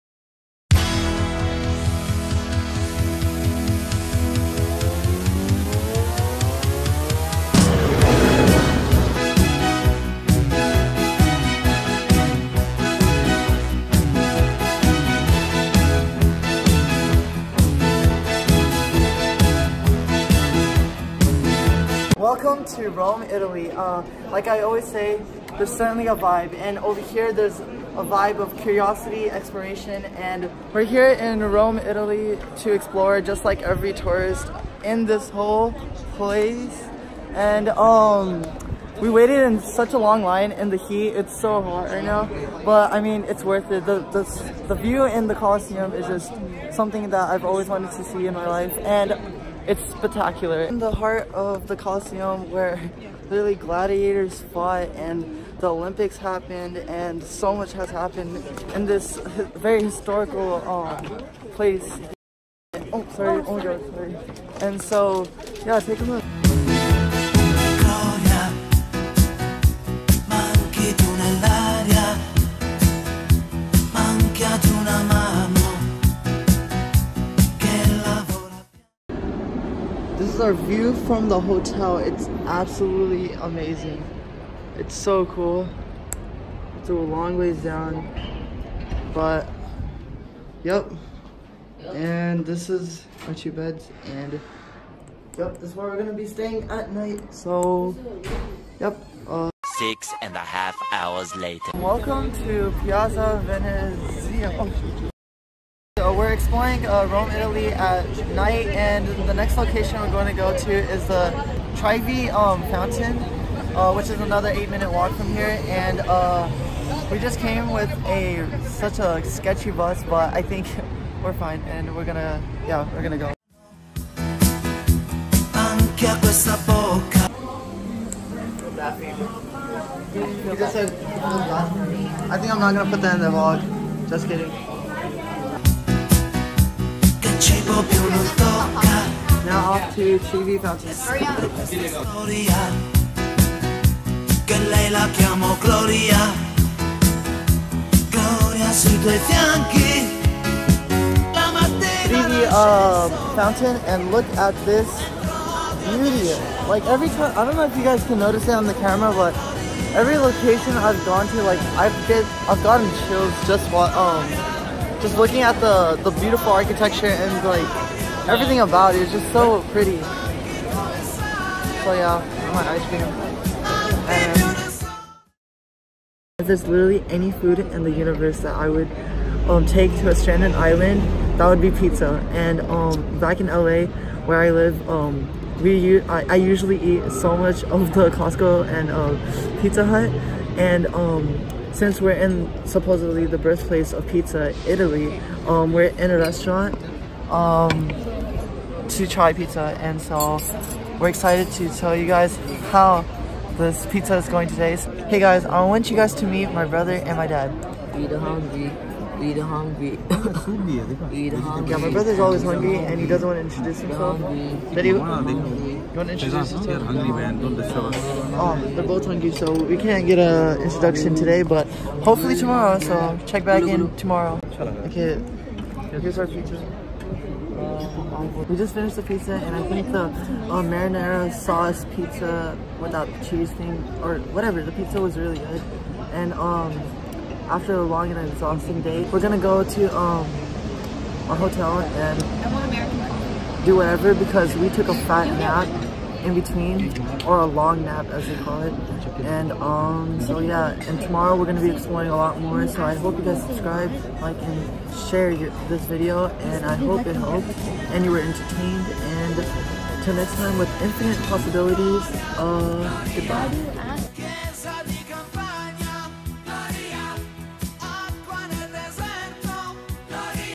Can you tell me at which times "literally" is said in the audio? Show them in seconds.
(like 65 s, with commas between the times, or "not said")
53 s, 176 s.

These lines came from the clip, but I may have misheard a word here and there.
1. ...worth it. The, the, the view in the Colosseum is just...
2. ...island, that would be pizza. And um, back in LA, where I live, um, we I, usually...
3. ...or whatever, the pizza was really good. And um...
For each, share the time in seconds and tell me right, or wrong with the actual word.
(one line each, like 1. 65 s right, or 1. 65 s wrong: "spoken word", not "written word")
1. 43 s right
2. 180 s right
3. 234 s right.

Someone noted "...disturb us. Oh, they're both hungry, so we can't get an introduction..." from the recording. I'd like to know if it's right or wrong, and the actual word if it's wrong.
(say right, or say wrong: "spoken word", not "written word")
right.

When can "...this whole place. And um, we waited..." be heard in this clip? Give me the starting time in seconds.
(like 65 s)
35 s.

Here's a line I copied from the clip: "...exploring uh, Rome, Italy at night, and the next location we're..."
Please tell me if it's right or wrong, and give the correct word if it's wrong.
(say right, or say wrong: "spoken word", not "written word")
right.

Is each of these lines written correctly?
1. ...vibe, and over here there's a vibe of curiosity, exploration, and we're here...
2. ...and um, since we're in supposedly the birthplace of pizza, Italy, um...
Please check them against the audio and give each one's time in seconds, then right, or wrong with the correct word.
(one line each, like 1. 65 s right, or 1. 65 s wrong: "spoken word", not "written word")
1. 26 s right
2. 190 s right.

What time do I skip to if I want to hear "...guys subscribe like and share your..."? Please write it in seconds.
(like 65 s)
253 s.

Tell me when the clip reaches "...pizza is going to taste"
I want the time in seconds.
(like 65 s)
203 s.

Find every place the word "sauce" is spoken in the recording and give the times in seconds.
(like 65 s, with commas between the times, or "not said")
231 s.